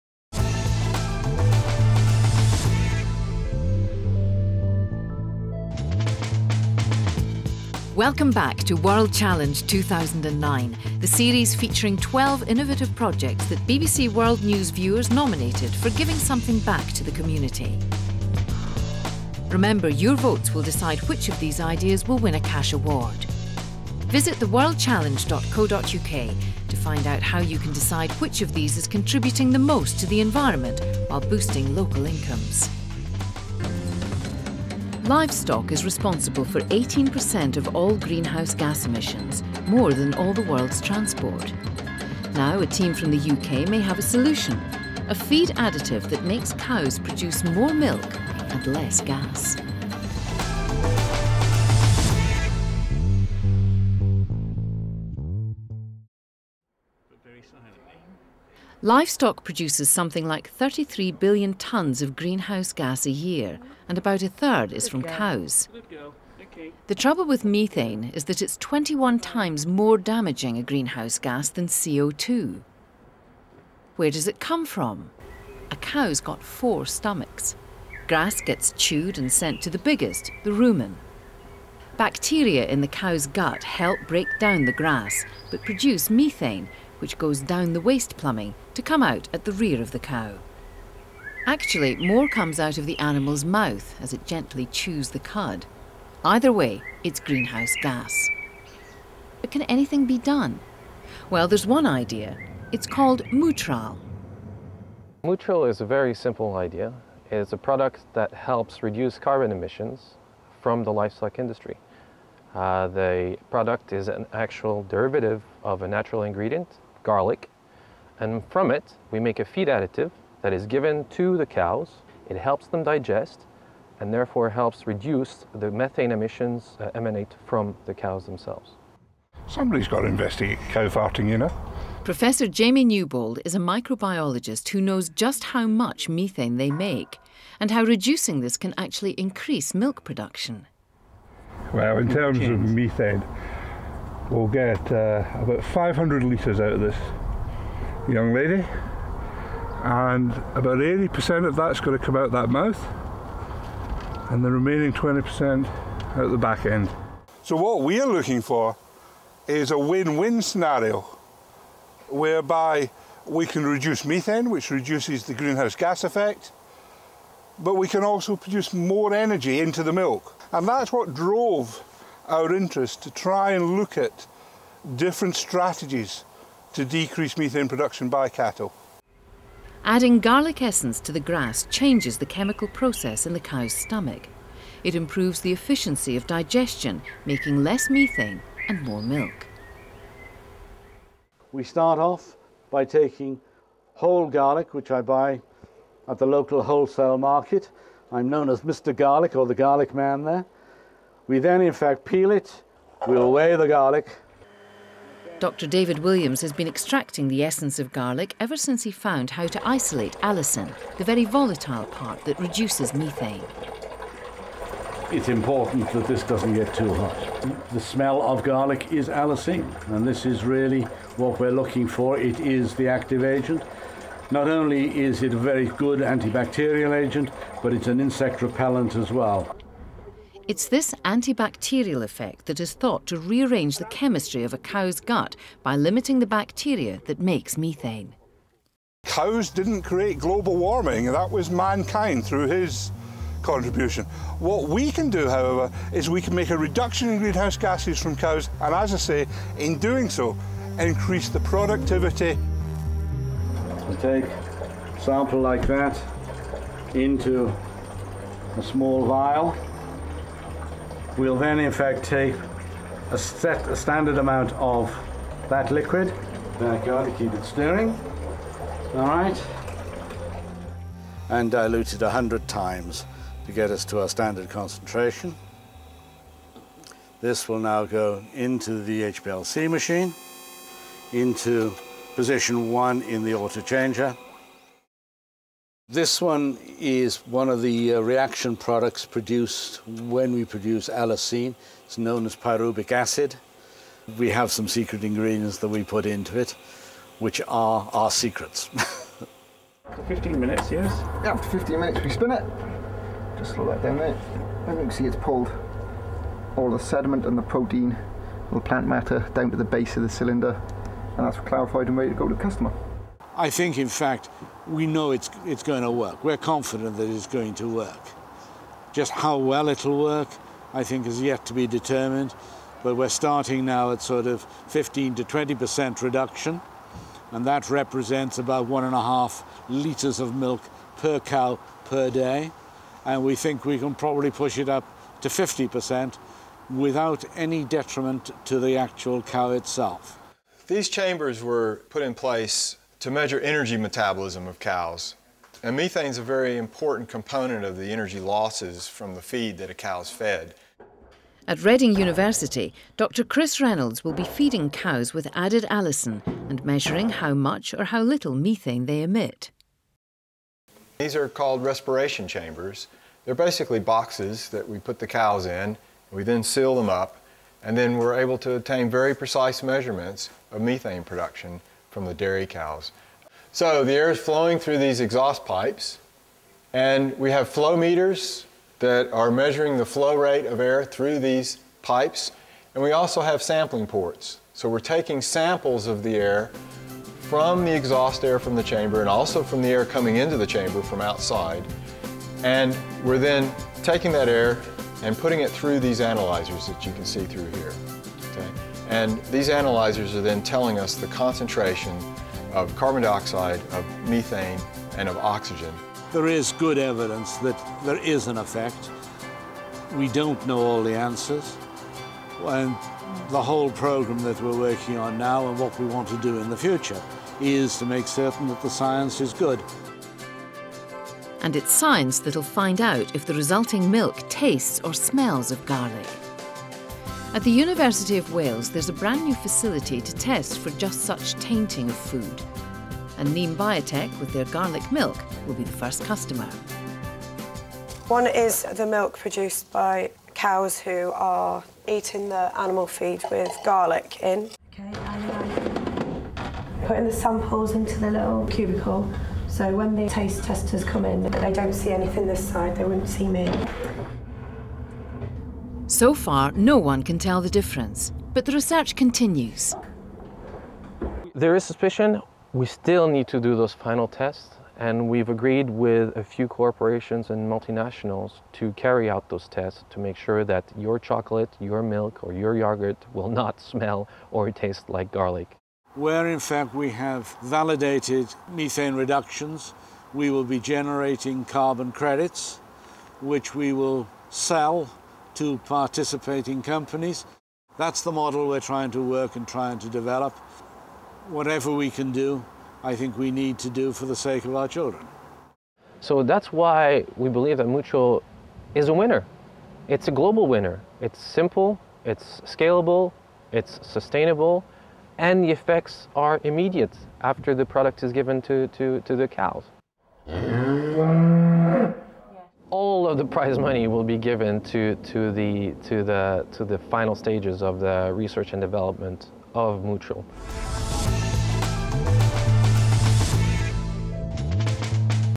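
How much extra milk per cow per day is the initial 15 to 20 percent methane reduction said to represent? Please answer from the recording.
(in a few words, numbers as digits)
1.5 litres.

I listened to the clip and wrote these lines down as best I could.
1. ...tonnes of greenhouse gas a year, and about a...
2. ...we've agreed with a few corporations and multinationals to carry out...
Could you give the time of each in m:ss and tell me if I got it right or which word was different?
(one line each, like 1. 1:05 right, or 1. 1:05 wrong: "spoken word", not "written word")
1. 1:01 right
2. 7:45 right.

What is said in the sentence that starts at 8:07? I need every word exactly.
That's the model we're trying to work and trying to develop.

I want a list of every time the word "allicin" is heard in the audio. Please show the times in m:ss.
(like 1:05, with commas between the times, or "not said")
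3:30, 3:39, 4:50, 5:55.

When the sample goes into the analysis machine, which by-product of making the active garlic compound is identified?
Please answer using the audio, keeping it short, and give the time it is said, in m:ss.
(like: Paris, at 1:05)
pyruvic acid, at 4:52.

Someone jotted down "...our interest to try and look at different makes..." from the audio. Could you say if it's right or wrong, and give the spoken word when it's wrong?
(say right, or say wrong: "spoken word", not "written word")
wrong: "strategies", not "makes".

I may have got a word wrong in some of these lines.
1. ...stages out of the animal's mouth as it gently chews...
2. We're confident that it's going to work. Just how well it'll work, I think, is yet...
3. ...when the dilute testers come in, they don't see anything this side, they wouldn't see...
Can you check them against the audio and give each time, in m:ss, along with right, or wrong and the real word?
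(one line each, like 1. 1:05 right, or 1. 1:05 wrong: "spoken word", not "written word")
1. 1:32 wrong: "comes", not "stages"
2. 5:16 right
3. 7:29 wrong: "taste", not "dilute".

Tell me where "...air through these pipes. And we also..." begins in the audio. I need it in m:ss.
6:20.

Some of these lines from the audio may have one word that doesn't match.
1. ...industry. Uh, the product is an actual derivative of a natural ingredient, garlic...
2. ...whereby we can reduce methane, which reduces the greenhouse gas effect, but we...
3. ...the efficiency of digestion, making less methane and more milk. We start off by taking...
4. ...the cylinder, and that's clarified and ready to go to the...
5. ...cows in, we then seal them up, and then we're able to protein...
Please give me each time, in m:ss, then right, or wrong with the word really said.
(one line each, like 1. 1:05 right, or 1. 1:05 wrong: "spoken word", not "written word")
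1. 1:51 right
2. 2:42 right
3. 3:05 right
4. 5:10 right
5. 6:05 wrong: "obtain", not "protein".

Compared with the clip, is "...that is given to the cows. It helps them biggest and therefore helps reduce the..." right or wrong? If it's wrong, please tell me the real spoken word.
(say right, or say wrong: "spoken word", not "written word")
wrong: "digest", not "biggest".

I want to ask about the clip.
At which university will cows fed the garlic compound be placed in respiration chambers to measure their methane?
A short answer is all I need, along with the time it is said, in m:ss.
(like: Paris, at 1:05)
Reading University, at 5:51.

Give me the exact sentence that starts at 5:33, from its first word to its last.
And we think we can probably push it up to 50% without any detriment to the actual cow itself.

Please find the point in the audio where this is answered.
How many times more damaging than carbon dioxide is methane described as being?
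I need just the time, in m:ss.
1:08.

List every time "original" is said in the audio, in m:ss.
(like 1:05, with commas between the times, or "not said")
not said.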